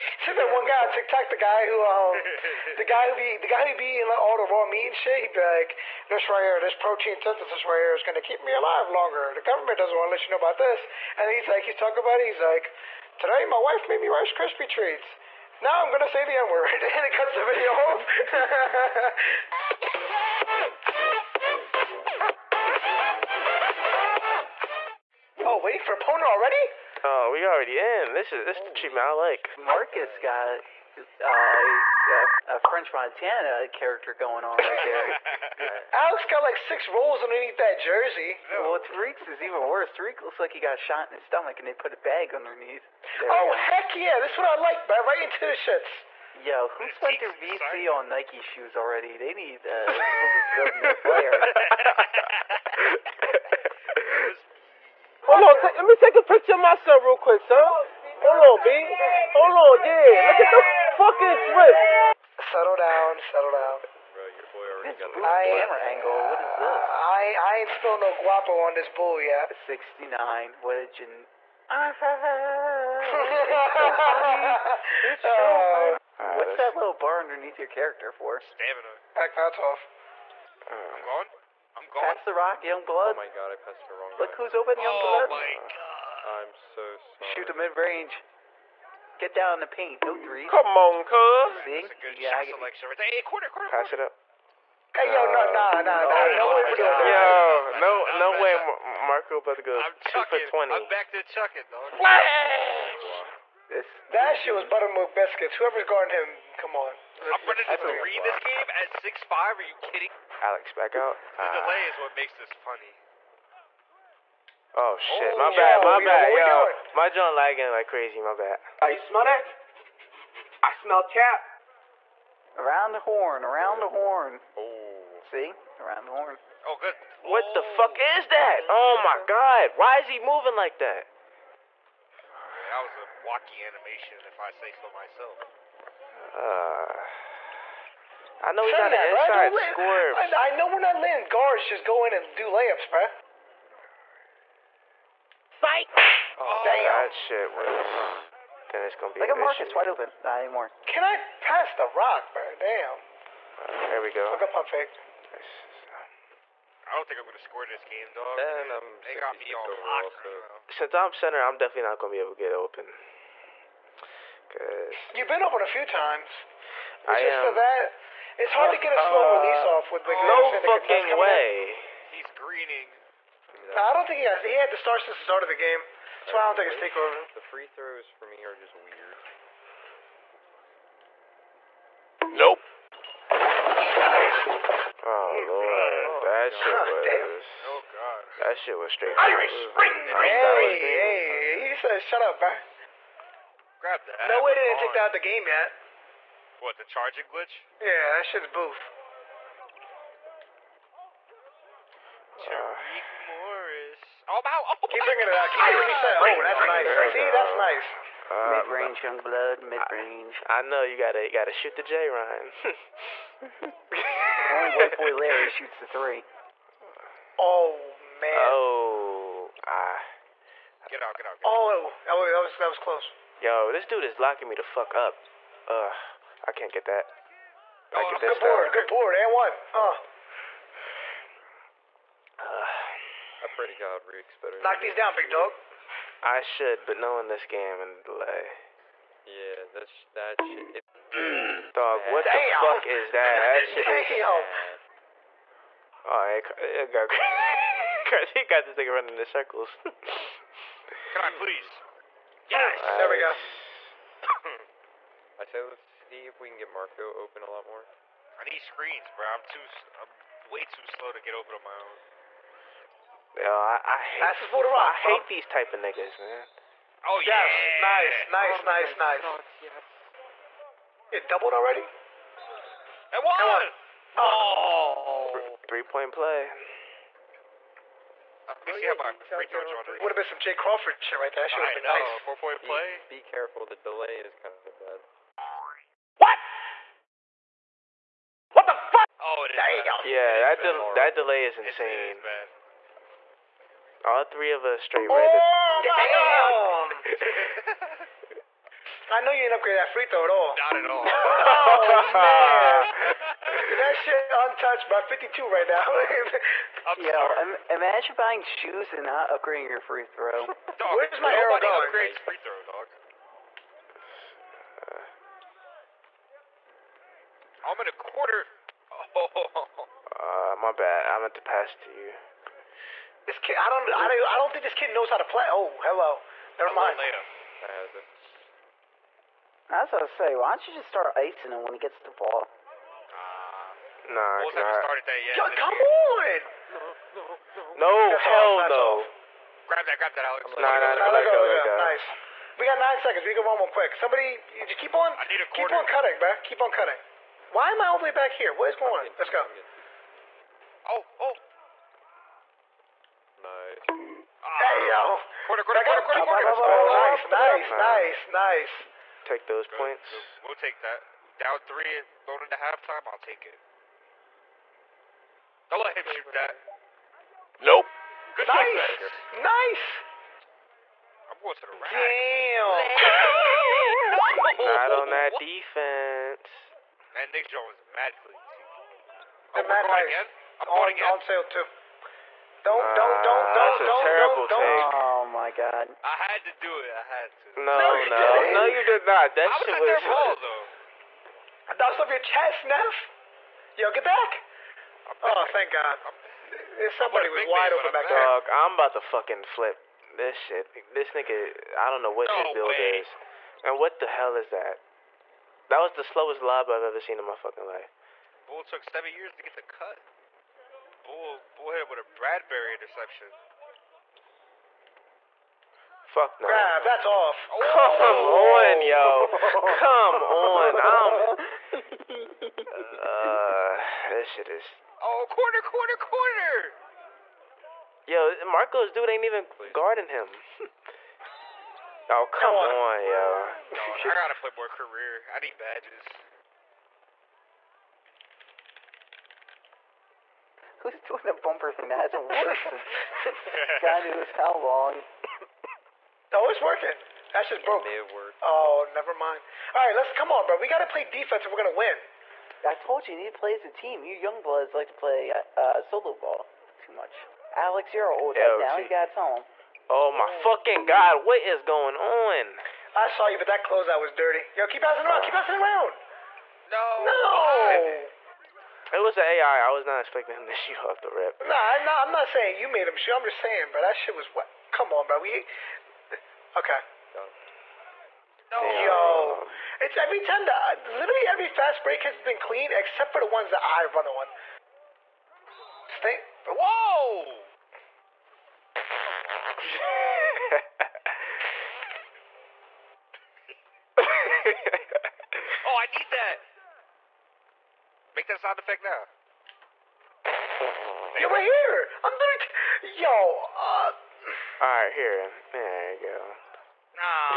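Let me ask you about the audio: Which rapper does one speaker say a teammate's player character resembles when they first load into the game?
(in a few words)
French Montana.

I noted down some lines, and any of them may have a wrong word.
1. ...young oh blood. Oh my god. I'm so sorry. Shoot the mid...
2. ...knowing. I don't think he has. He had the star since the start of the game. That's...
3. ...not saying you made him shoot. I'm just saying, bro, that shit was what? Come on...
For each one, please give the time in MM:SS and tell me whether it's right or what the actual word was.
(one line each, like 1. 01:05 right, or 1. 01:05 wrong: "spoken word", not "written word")
1. 01:24 right
2. 02:52 wrong: "greening", not "knowing"
3. 07:52 right.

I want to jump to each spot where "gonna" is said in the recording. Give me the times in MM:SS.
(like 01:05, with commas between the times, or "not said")
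02:28, 02:37, 02:41, 07:31.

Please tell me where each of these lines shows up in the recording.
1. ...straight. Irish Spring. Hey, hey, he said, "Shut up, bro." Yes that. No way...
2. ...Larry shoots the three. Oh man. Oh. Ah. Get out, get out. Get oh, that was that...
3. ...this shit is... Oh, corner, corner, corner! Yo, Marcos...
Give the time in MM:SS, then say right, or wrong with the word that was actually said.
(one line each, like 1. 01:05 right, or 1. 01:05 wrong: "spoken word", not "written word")
1. 03:08 wrong: "Grab", not "Yes"
2. 03:35 right
3. 07:04 right.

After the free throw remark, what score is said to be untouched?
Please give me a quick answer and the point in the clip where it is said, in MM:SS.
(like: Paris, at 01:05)
52, at 05:05.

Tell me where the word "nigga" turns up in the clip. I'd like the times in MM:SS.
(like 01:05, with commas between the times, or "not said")
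04:08, 04:25, 06:41.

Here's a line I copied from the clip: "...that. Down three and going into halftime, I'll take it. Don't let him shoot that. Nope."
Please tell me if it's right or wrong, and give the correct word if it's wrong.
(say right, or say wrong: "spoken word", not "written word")
right.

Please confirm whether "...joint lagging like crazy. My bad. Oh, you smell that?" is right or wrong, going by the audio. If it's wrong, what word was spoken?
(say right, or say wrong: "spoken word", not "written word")
right.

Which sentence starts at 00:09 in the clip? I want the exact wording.
The government doesn't want to let you know about this." And he's like, he's talking about it.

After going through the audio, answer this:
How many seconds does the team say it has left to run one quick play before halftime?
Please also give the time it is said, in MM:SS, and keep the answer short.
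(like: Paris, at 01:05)
9, at 05:42.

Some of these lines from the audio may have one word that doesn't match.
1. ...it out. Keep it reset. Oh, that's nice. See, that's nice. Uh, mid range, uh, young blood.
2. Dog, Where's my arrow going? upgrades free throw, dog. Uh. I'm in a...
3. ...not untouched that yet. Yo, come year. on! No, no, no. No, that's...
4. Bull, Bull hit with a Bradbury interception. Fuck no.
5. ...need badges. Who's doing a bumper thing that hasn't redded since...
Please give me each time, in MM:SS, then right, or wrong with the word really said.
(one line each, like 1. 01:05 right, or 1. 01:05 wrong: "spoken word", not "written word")
1. 03:25 right
2. 05:10 right
3. 05:34 wrong: "started", not "untouched"
4. 06:51 right
5. 07:15 wrong: "worked", not "redded".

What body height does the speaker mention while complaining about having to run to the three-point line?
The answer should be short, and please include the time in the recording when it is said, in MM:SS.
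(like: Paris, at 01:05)
6'5", at 01:48.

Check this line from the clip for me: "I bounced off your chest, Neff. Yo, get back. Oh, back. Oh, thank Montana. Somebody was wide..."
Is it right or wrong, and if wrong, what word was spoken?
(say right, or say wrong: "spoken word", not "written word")
wrong: "God", not "Montana".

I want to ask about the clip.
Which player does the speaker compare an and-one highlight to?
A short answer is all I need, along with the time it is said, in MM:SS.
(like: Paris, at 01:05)
Jay Crawford, at 04:40.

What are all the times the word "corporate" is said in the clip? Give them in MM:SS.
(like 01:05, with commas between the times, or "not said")
not said.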